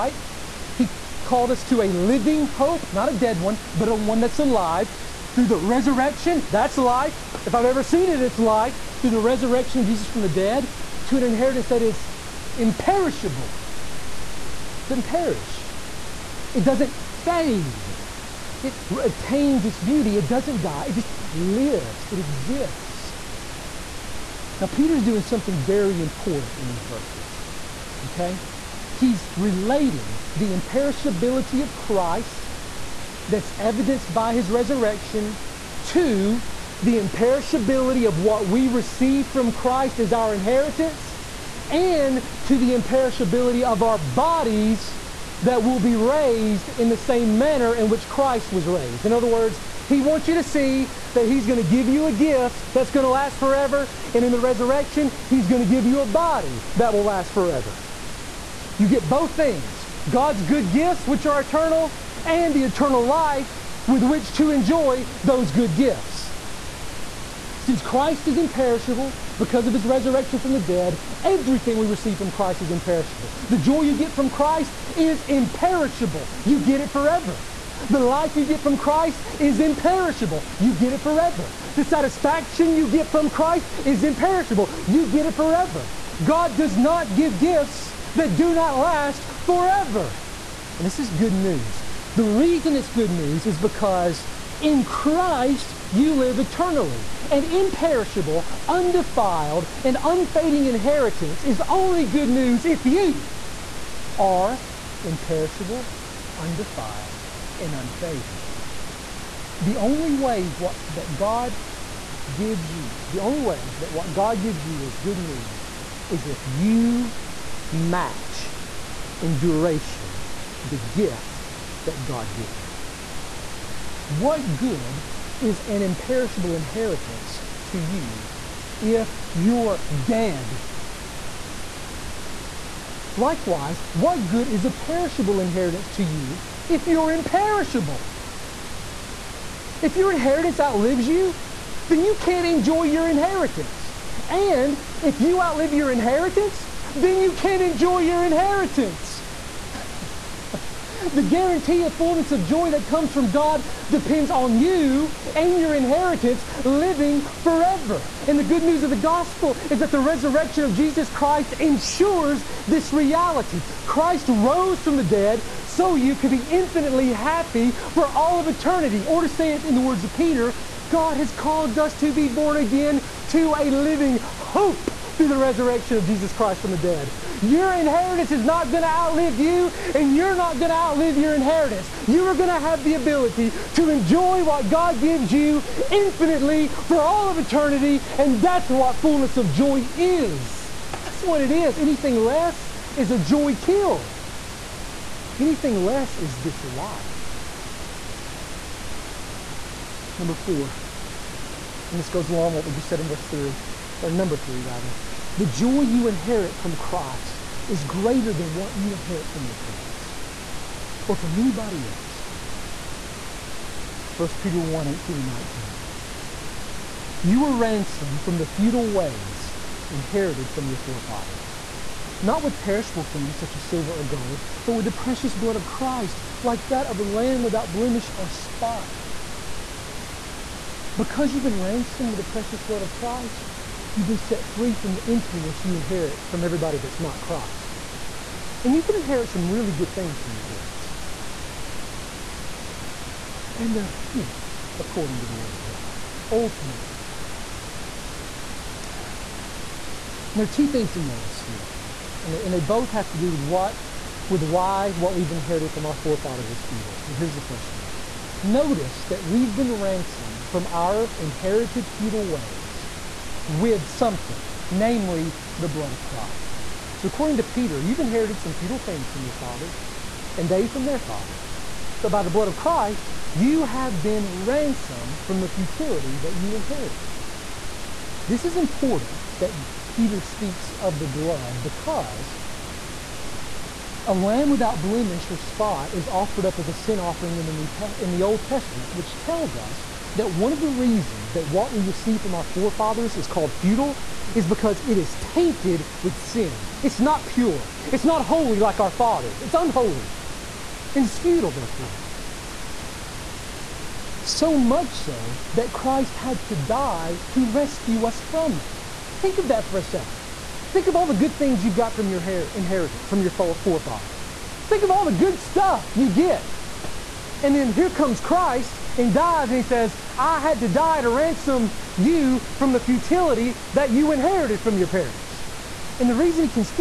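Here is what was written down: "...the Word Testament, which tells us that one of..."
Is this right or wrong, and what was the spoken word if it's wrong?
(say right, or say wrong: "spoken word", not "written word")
wrong: "Old", not "Word".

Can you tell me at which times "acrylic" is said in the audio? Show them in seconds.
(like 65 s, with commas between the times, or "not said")
not said.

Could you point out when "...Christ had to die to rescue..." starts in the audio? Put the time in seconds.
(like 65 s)
305 s.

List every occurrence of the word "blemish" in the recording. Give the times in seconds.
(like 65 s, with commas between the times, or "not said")
227 s, 284 s.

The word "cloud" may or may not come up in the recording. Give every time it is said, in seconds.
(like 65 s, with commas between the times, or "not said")
not said.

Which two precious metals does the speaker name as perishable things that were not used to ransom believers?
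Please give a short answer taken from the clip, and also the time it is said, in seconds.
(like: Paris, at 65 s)
silver or gold, at 223 s.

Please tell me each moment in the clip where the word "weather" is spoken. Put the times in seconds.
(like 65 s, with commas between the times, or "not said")
not said.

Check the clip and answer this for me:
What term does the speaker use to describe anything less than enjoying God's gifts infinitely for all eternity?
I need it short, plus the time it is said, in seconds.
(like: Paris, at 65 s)
joy kill, at 193 s.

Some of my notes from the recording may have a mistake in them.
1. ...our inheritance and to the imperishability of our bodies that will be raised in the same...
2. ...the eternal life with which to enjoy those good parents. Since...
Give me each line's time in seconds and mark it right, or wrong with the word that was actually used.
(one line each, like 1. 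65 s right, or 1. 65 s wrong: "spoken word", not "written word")
1. 40 s right
2. 62 s wrong: "gifts", not "parents".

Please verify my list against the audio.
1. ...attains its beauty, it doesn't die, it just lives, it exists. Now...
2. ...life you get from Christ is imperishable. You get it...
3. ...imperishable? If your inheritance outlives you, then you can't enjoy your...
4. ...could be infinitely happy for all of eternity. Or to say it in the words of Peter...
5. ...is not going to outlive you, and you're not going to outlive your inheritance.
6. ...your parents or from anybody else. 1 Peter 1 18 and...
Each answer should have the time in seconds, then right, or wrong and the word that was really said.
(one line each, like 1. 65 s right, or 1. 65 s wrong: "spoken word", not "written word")
1. 19 s right
2. 77 s right
3. 137 s right
4. 166 s right
5. 178 s right
6. 209 s right.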